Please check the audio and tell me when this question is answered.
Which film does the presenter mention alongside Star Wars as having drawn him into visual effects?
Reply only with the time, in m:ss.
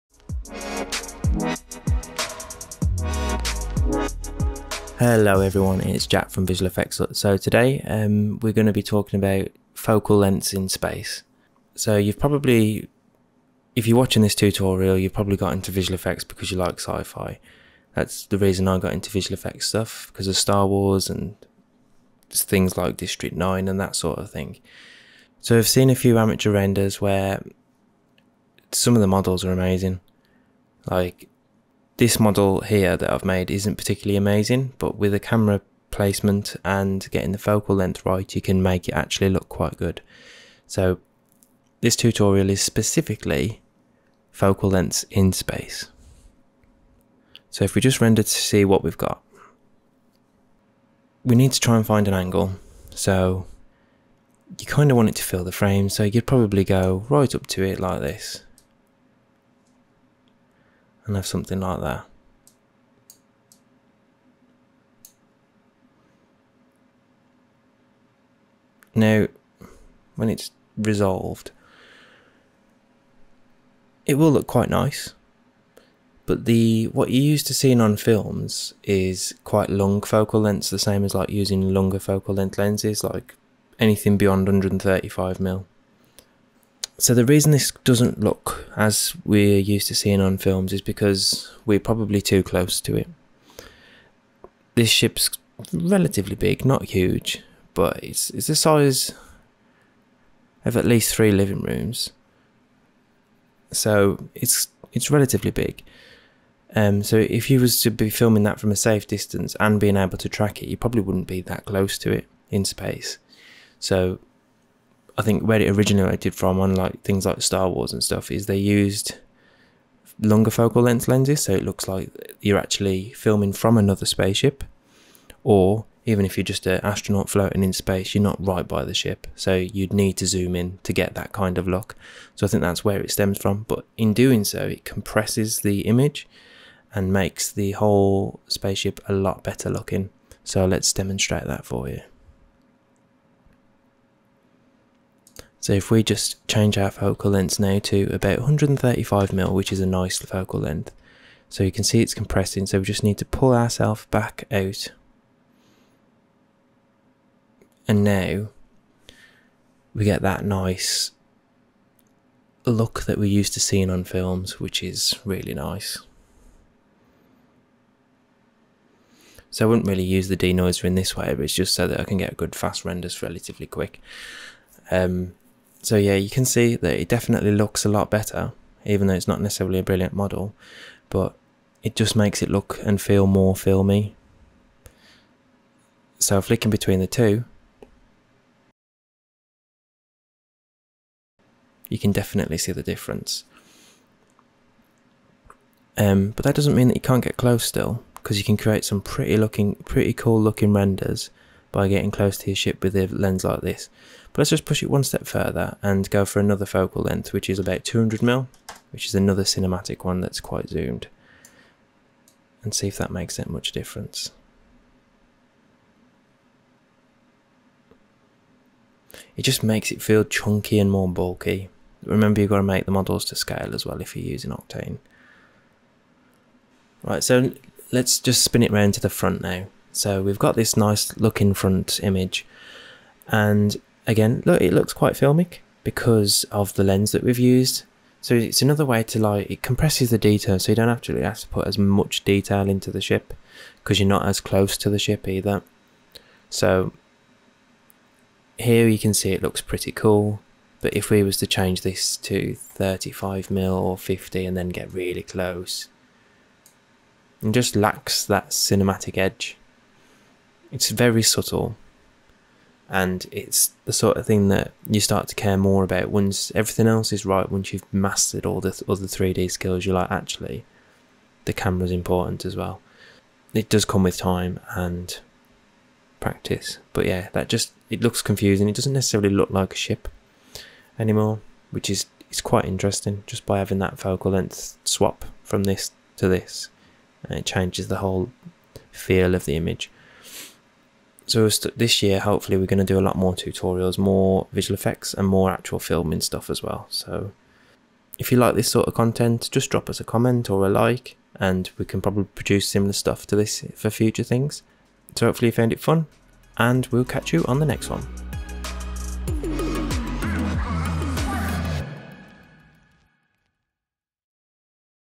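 0:22.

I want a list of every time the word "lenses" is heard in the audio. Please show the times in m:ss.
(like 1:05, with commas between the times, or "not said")
1:22, 2:01.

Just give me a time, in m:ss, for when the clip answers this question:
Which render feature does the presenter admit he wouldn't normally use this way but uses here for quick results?
2:50.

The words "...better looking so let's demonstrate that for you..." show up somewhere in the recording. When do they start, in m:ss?
2:19.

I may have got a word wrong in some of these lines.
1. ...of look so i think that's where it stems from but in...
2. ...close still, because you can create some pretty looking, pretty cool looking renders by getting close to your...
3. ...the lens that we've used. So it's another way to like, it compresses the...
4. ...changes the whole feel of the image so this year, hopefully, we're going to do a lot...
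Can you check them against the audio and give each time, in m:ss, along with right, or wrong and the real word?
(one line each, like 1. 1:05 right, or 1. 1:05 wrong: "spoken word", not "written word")
1. 2:11 right
2. 3:17 right
3. 3:56 right
4. 4:47 right.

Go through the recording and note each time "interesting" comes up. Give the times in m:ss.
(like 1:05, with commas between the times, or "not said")
4:42.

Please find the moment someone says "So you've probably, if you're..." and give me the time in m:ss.
0:11.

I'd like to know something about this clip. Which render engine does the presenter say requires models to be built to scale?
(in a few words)
Octane.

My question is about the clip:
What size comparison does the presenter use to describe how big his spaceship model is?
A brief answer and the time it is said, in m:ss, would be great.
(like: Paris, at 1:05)
three living rooms, at 1:41.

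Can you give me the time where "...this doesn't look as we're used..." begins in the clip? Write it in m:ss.
1:27.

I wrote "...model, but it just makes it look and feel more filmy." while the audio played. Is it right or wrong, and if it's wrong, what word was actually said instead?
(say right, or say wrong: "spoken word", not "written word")
right.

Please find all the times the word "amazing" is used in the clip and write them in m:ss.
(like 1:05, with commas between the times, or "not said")
0:29, 0:34.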